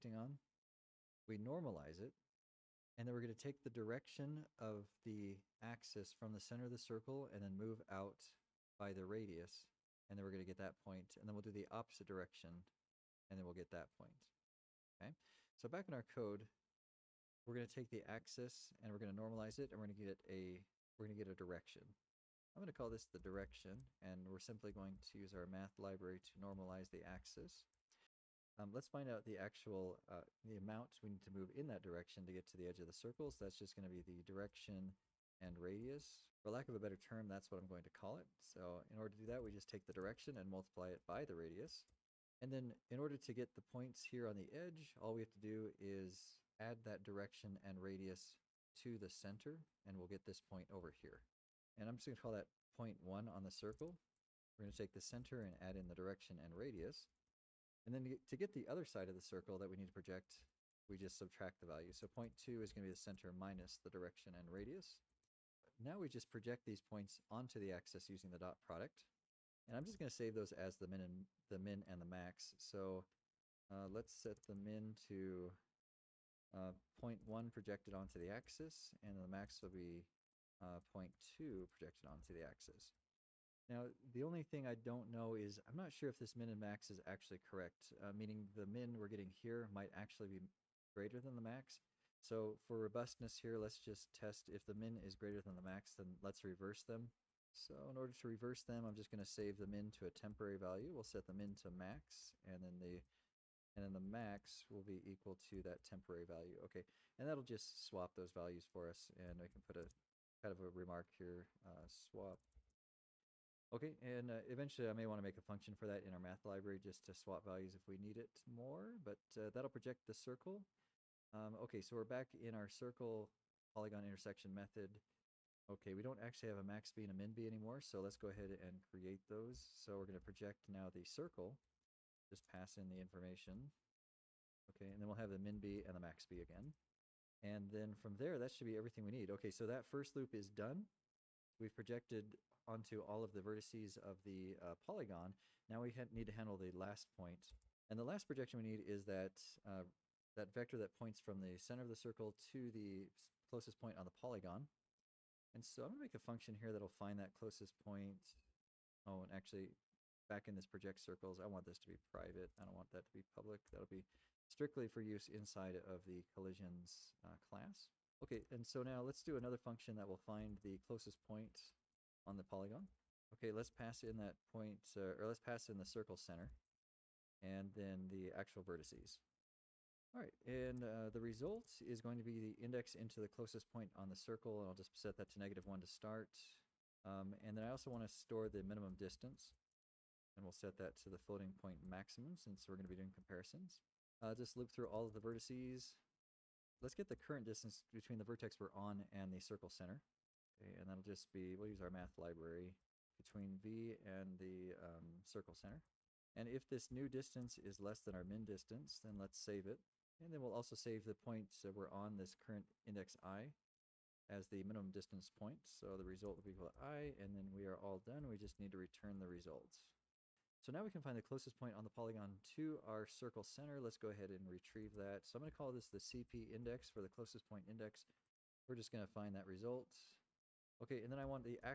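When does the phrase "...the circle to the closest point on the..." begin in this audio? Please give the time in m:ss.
2:31.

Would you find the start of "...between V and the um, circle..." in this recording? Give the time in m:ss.
3:23.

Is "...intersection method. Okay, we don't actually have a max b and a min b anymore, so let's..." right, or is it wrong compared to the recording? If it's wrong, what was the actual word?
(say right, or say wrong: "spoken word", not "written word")
right.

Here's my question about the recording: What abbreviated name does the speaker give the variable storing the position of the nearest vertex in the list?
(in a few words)
CP index.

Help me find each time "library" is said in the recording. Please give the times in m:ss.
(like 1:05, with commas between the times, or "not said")
0:25, 1:56, 3:22.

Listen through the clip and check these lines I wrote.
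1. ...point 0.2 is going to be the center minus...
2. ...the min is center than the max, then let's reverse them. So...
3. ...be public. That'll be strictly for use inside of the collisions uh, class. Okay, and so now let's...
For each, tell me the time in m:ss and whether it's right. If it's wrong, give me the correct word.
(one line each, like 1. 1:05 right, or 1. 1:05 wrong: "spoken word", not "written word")
1. 1:02 right
2. 1:34 wrong: "greater", not "center"
3. 2:43 right.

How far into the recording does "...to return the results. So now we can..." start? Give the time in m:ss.
3:38.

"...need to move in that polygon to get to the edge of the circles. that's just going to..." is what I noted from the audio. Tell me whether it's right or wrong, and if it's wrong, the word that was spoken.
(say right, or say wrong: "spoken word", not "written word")
wrong: "direction", not "polygon".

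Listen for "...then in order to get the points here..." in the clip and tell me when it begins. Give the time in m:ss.
0:42.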